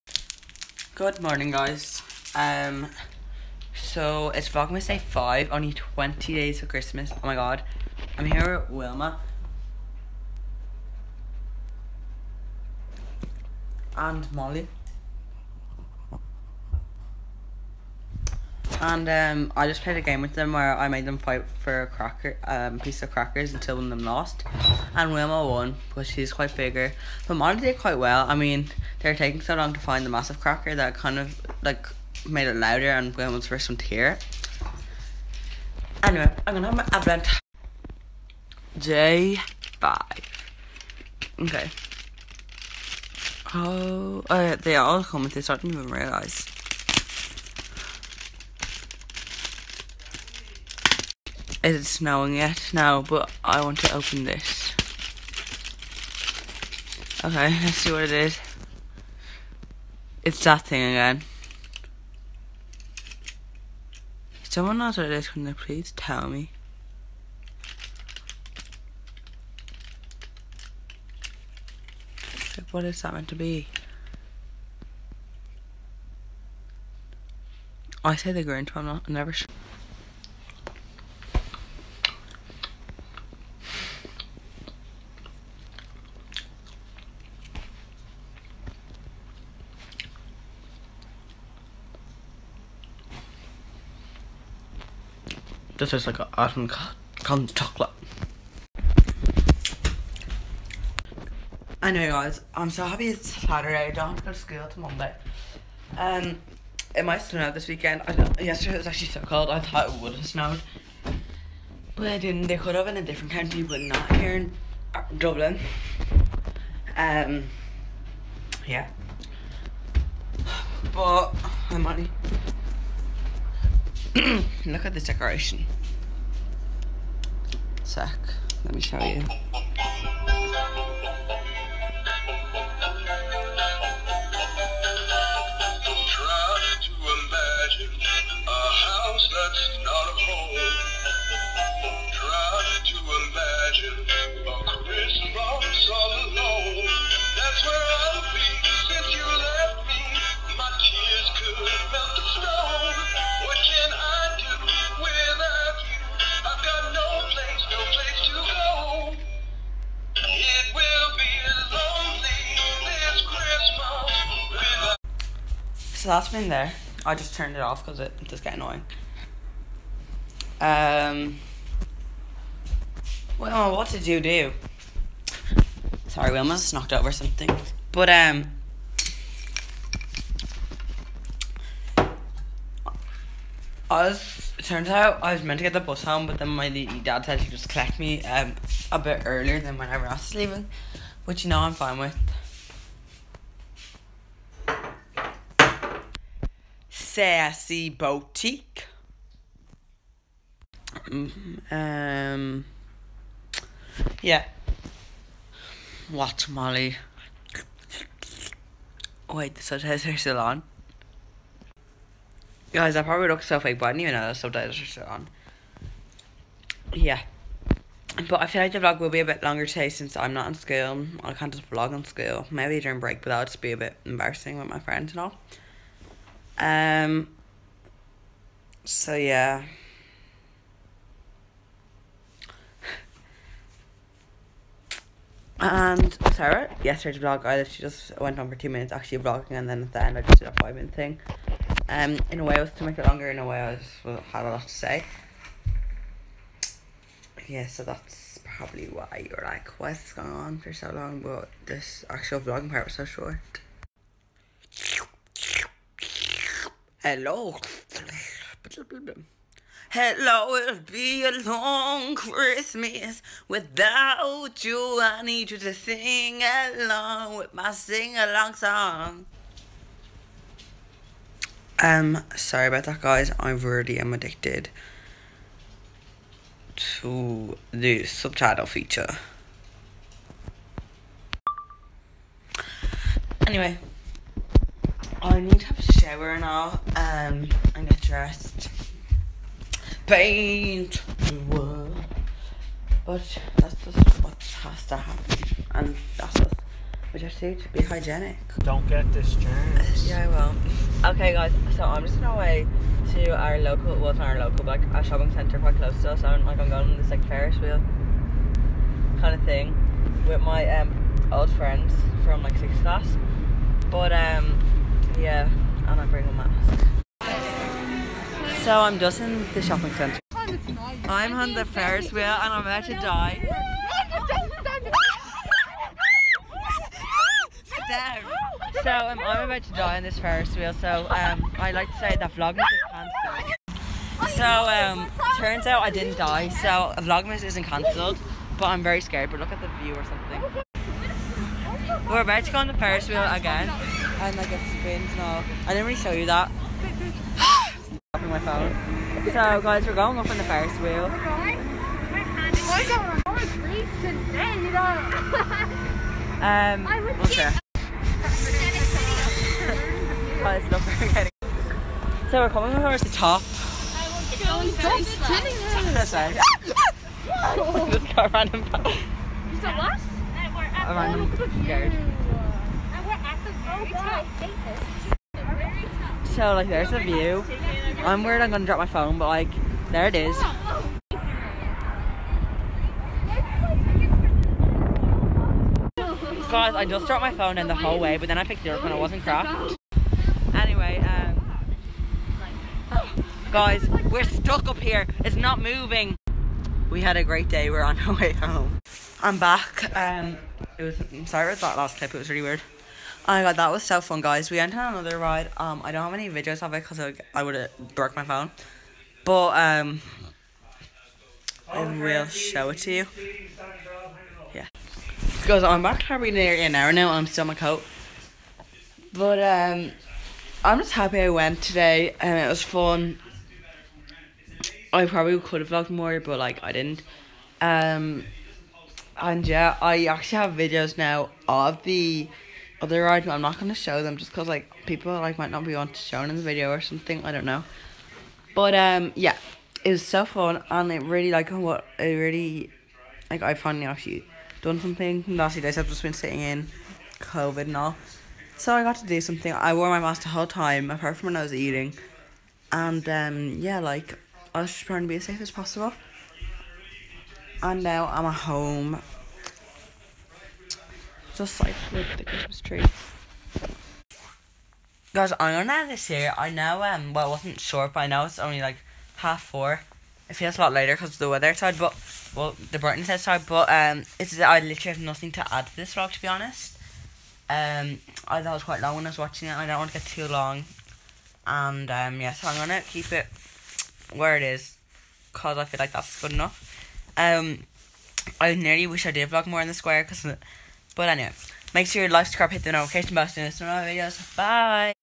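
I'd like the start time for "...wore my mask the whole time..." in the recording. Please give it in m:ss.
7:29.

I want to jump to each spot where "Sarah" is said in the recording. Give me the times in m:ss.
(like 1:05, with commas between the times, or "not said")
3:56.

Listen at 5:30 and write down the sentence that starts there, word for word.
So um, I like to say that Vlogmas is cancelled.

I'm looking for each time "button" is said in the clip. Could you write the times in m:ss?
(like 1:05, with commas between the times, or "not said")
8:13.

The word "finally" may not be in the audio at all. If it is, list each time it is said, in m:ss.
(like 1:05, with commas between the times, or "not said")
7:23.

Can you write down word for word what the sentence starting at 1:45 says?
Um, it might snow this weekend.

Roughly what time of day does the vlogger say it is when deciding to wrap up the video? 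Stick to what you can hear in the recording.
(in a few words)
half four.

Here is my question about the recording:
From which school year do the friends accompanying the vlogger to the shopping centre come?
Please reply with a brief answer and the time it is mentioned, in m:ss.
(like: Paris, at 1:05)
sixth class, at 5:12.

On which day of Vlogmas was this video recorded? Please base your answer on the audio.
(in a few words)
Day 5.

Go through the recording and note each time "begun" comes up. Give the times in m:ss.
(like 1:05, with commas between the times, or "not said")
not said.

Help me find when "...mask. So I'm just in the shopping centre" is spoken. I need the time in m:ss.
5:16.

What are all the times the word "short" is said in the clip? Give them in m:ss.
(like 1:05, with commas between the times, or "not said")
4:13, 7:47.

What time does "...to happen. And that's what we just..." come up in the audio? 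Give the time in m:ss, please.
4:54.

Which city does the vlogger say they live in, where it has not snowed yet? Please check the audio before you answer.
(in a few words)
Dublin.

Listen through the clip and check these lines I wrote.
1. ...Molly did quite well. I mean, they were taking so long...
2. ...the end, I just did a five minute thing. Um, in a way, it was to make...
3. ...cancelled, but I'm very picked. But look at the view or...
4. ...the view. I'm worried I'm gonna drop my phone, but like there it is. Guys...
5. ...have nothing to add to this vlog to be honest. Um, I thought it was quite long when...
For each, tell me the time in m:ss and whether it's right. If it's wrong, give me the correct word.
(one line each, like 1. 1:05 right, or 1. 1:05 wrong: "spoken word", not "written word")
1. 0:27 right
2. 3:59 right
3. 5:37 wrong: "scared", not "picked"
4. 6:16 right
5. 7:54 right.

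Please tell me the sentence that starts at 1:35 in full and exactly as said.
This tastes like an awesome cotton chocolate.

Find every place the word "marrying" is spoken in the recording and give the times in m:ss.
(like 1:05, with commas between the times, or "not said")
not said.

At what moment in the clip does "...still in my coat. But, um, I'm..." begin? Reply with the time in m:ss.
6:57.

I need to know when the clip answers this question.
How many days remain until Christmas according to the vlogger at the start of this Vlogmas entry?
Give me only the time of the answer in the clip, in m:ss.
0:05.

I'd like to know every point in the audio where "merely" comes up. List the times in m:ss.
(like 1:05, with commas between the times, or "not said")
not said.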